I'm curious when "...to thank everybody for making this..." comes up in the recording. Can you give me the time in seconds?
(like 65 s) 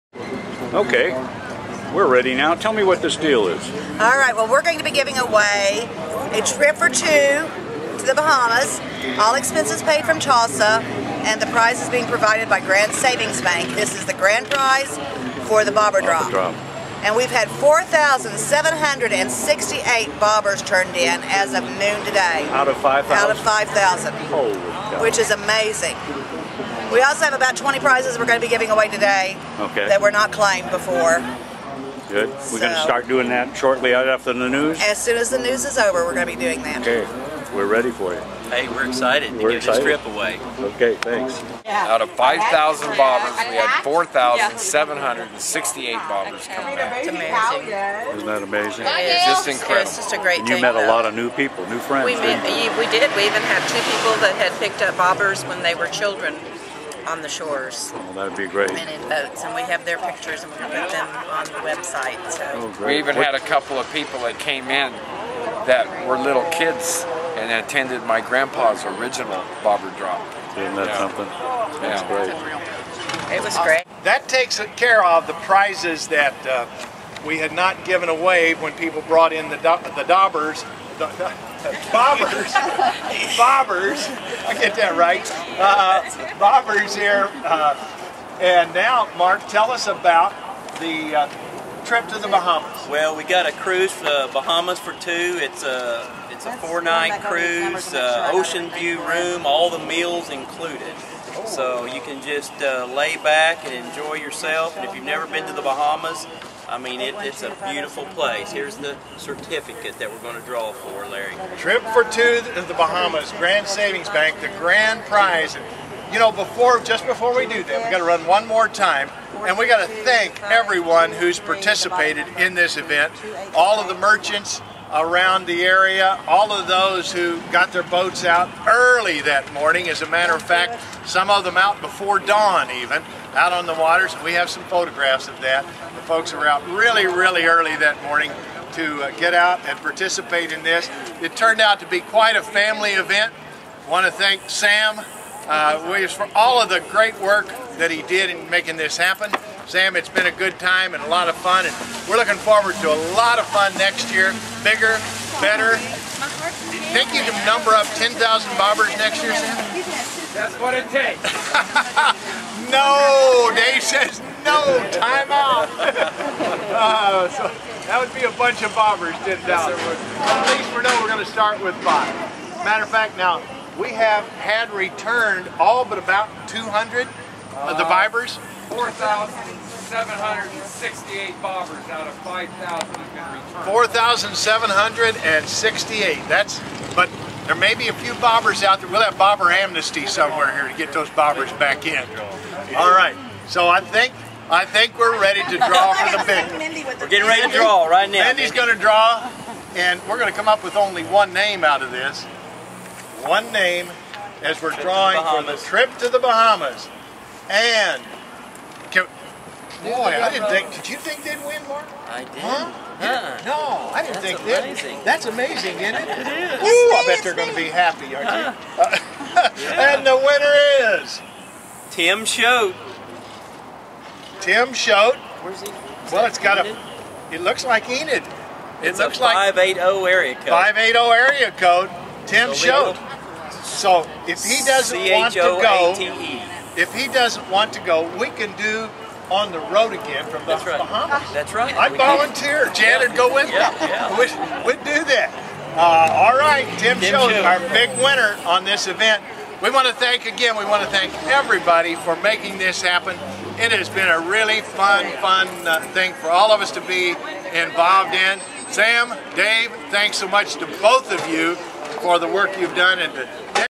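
250 s.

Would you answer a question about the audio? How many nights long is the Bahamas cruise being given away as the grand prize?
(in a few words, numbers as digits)
4.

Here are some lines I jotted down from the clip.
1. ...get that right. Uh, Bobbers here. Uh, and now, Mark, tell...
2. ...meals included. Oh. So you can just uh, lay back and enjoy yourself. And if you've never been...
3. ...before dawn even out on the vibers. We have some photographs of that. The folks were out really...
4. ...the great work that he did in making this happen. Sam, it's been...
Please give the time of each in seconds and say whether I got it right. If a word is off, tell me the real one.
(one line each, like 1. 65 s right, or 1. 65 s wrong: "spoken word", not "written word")
1. 84 s right
2. 99 s right
3. 131 s wrong: "waters", not "vibers"
4. 146 s right.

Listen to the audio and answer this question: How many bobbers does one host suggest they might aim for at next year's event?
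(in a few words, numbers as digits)
10,000.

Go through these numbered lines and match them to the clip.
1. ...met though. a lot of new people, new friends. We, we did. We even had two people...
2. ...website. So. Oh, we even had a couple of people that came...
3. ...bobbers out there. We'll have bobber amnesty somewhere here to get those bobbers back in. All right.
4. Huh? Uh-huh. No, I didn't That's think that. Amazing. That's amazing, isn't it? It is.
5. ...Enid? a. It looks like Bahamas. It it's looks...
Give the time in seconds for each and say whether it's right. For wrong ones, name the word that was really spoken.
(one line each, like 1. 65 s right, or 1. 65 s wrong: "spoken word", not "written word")
1. 50 s right
2. 61 s right
3. 188 s right
4. 212 s right
5. 226 s wrong: "Enid", not "Bahamas".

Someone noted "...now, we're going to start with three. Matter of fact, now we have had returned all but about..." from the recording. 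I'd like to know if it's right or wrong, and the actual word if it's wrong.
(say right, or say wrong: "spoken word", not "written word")
wrong: "five", not "three".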